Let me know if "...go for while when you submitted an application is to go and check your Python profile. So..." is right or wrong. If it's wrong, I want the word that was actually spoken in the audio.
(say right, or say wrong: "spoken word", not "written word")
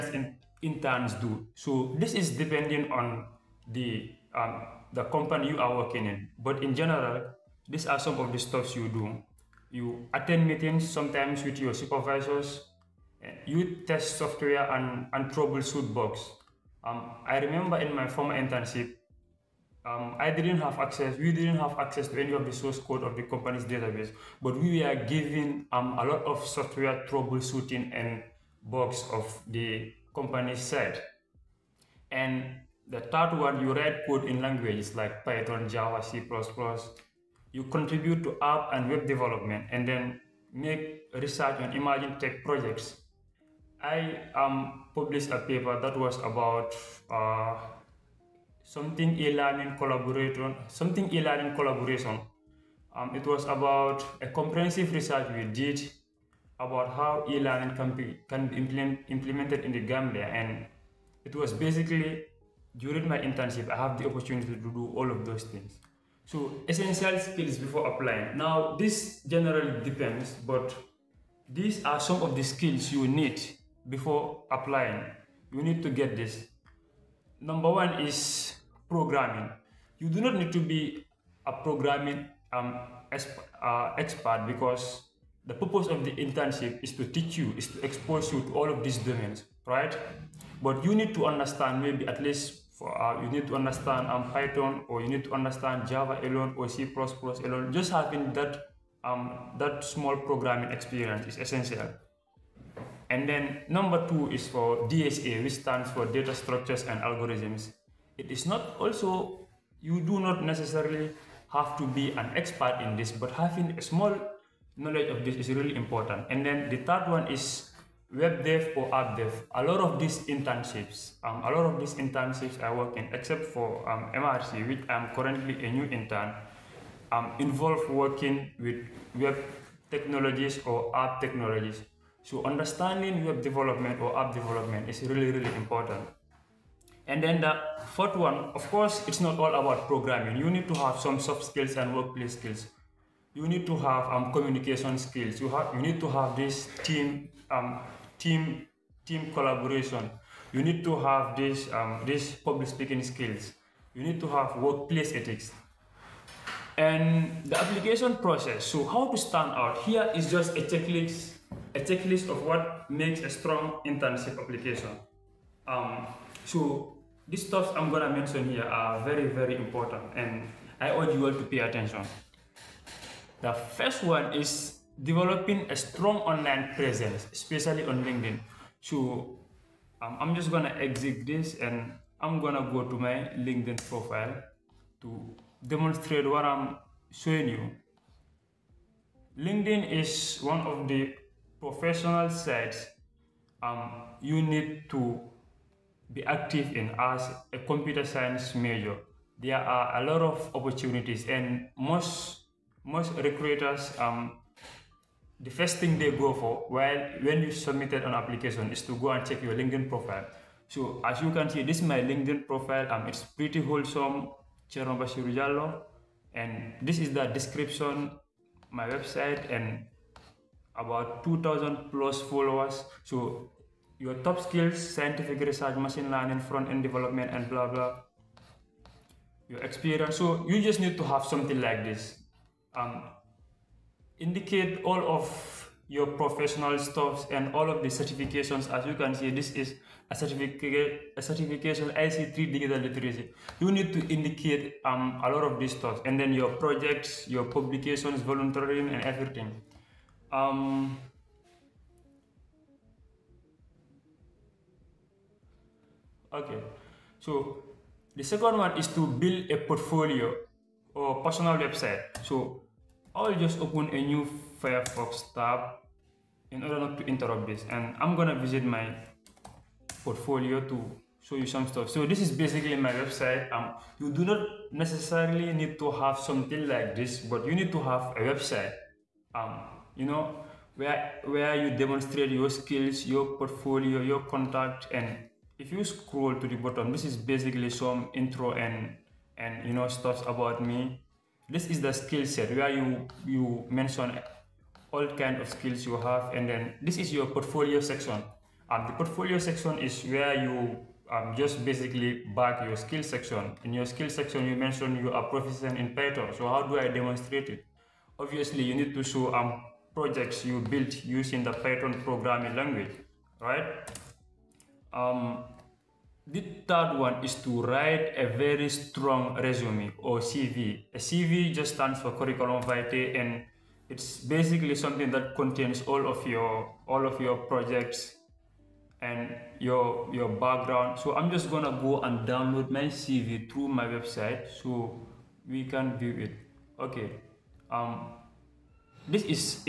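wrong: "LinkedIn", not "Python".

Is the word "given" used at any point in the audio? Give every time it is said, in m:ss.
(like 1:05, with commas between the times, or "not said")
0:25.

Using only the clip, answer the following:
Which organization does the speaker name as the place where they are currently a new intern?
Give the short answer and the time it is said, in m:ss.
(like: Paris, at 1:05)
MRC, at 2:04.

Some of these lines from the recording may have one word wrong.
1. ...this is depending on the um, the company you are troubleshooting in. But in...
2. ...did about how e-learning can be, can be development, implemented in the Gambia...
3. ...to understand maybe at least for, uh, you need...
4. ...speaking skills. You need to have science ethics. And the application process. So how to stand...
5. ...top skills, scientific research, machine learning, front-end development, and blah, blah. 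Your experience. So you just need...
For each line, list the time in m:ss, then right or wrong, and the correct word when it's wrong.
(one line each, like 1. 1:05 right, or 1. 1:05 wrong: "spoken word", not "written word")
1. 0:01 wrong: "working", not "troubleshooting"
2. 0:55 wrong: "implement", not "development"
3. 1:31 right
4. 2:32 wrong: "workplace", not "science"
5. 3:44 right.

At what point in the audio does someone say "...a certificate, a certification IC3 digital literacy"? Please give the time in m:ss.
4:00.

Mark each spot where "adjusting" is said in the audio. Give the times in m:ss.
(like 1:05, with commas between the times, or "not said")
not said.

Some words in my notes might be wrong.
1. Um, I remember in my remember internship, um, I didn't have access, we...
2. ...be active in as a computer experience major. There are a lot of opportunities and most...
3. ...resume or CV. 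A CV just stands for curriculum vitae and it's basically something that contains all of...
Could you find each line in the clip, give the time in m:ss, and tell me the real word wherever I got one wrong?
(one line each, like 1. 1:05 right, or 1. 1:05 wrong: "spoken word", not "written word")
1. 0:16 wrong: "former", not "remember"
2. 3:16 wrong: "science", not "experience"
3. 5:19 right.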